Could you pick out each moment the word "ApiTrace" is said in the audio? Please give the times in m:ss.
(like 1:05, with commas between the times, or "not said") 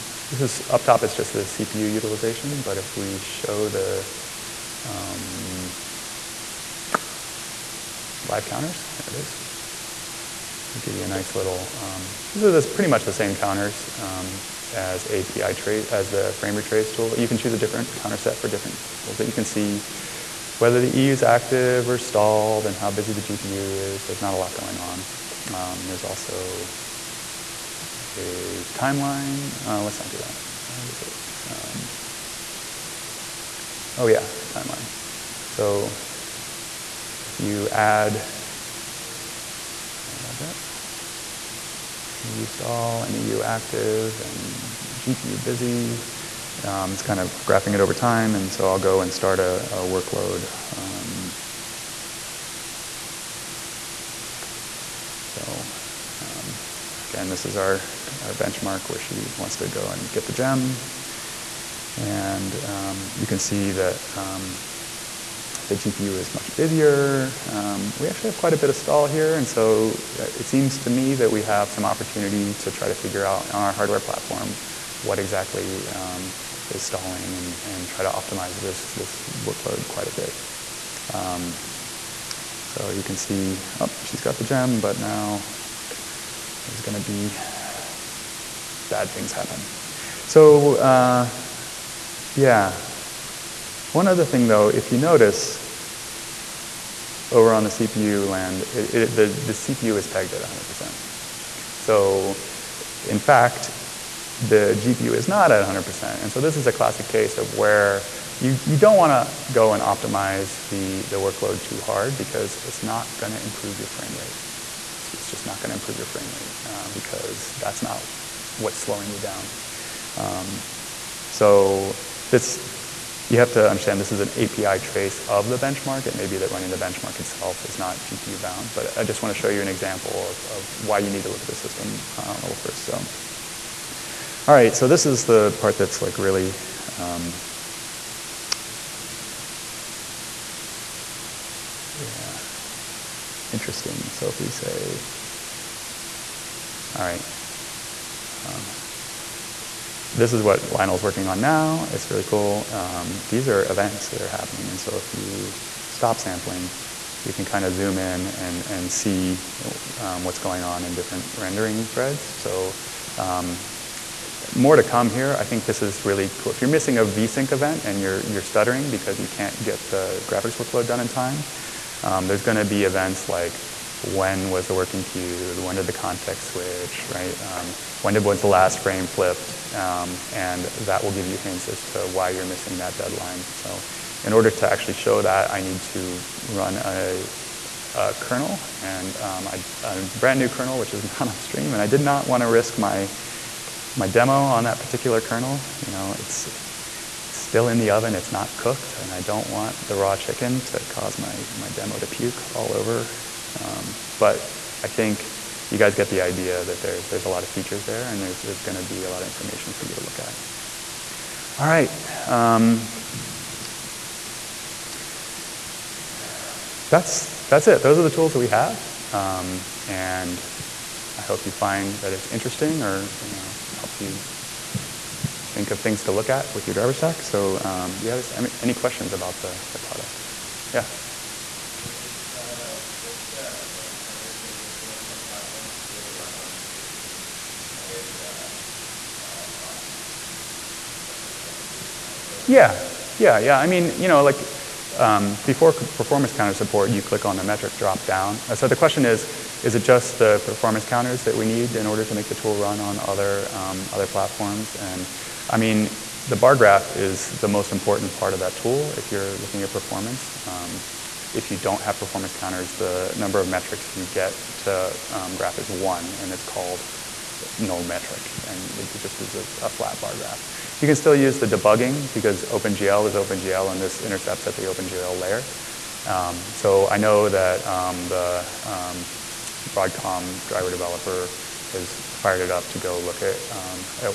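0:15, 2:04.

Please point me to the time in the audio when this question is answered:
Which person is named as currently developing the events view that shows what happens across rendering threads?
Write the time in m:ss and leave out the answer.
2:30.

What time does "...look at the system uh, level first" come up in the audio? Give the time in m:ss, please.
2:11.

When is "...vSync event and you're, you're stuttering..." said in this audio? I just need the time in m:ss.
2:47.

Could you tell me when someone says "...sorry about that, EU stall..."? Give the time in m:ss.
0:39.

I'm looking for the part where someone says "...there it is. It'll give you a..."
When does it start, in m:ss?
0:09.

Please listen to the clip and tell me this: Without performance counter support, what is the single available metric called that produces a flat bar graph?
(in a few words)
null metric.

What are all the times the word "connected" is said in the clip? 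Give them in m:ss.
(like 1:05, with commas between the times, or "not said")
not said.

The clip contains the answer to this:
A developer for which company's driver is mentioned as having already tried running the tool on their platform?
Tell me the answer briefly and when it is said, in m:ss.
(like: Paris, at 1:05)
Broadcom, at 4:39.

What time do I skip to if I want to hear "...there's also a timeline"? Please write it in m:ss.
0:25.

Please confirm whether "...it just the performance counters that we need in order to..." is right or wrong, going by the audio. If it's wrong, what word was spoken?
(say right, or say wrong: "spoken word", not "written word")
right.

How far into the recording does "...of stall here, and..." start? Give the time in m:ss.
1:08.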